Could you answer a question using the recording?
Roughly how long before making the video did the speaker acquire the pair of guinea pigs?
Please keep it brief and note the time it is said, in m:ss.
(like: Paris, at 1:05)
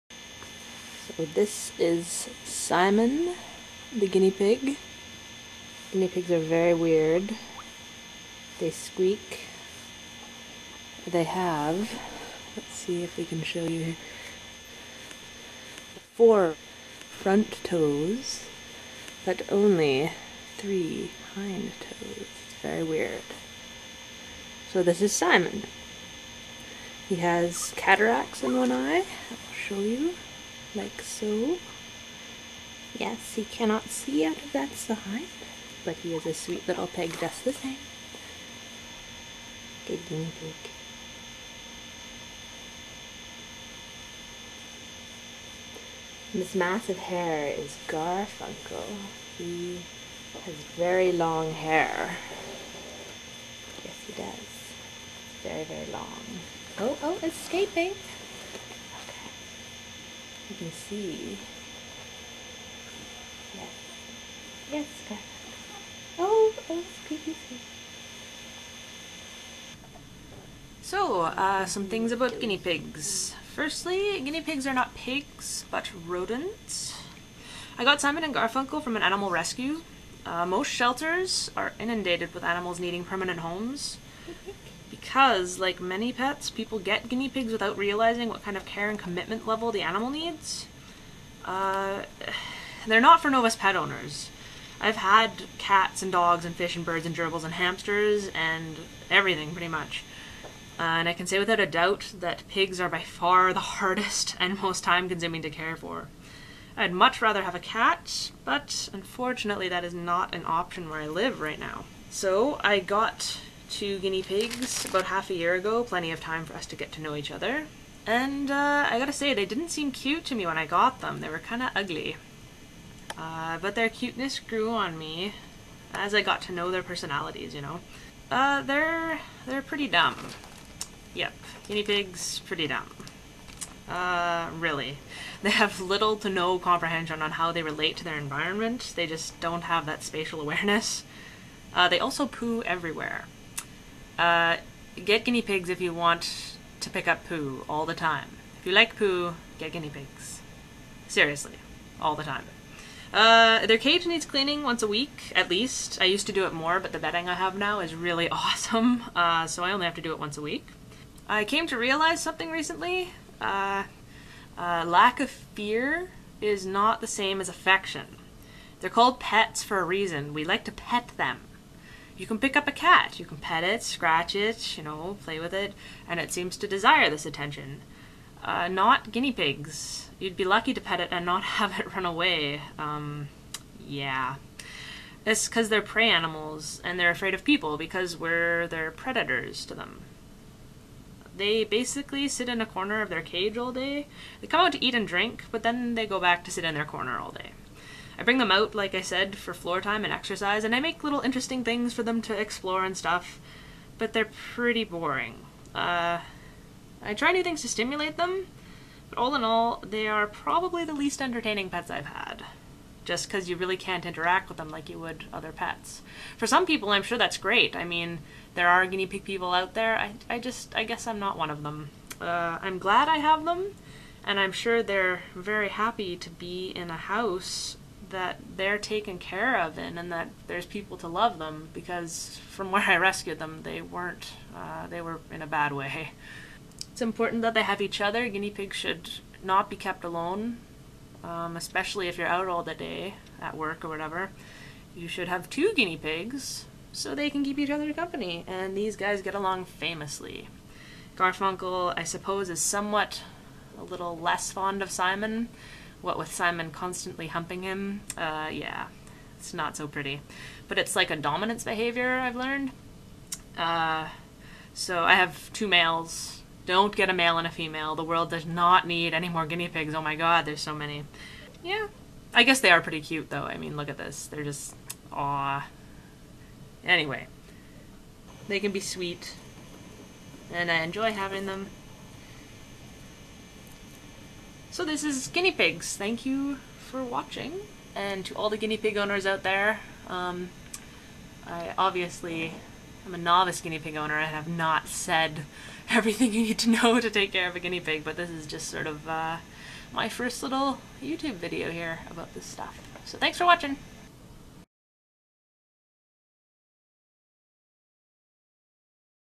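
Half a year, at 1:55.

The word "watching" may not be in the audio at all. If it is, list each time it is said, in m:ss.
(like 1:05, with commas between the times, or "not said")
4:47, 5:03.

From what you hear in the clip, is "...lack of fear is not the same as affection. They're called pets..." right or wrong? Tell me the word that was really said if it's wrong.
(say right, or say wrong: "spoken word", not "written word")
right.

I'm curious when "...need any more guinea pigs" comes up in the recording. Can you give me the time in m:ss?
4:28.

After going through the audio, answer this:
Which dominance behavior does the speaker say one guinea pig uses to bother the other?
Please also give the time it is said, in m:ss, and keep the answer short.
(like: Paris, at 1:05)
Humping, at 4:17.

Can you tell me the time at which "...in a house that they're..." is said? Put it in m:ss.
3:46.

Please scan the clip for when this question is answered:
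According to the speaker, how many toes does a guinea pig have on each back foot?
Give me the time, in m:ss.
0:20.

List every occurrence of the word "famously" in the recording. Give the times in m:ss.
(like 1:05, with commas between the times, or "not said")
4:09.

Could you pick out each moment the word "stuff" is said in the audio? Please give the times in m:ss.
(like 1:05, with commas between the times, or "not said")
3:22, 5:02.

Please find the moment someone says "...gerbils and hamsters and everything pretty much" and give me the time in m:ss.
1:37.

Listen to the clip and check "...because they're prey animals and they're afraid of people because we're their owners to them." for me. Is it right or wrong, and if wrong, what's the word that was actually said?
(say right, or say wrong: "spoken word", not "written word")
wrong: "predators", not "owners".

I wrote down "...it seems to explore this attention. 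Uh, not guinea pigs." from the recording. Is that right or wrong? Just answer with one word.
wrong.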